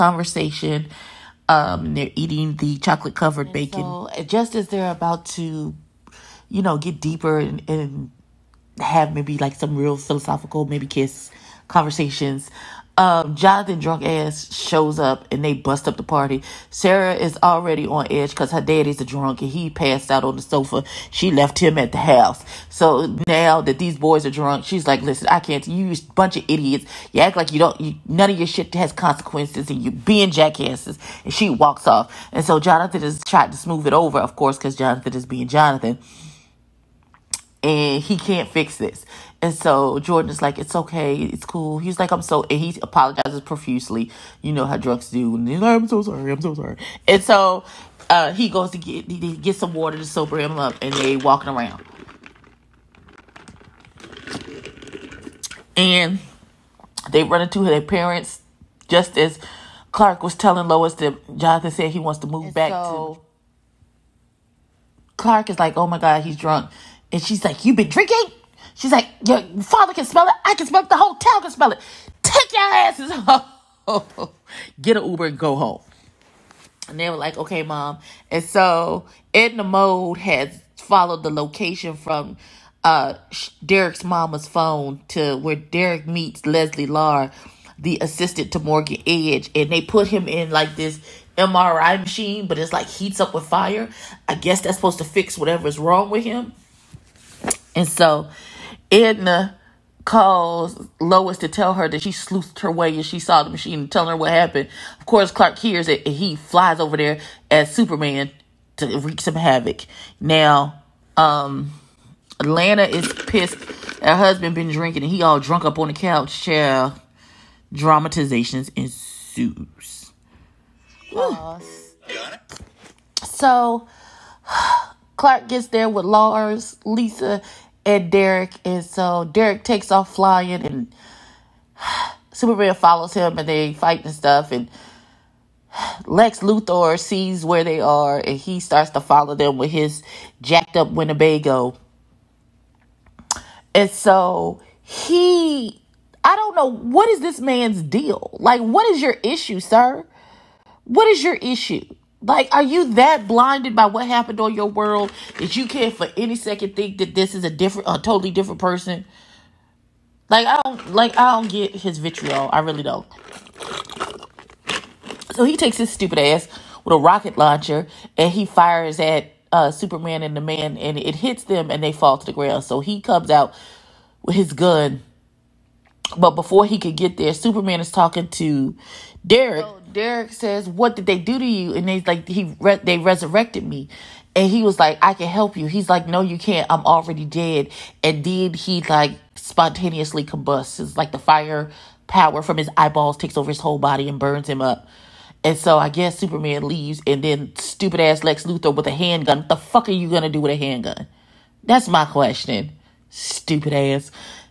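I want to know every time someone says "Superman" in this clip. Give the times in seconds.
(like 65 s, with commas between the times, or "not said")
107 s, 132 s, 169 s, 177 s, 196 s.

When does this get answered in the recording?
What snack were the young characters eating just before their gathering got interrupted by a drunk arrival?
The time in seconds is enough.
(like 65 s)
2 s.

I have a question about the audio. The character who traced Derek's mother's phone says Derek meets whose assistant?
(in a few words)
Morgan Edge.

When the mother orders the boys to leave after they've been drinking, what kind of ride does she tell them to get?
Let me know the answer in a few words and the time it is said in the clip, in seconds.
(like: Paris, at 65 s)
Uber, at 75 s.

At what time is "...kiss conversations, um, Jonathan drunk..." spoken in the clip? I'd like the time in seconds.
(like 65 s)
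10 s.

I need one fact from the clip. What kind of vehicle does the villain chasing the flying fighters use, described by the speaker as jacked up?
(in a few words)
Winnebago.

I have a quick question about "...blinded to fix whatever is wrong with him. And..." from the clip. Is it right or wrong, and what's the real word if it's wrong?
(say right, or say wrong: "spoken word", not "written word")
wrong: "supposed", not "blinded".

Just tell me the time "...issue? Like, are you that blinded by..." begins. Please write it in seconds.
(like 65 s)
151 s.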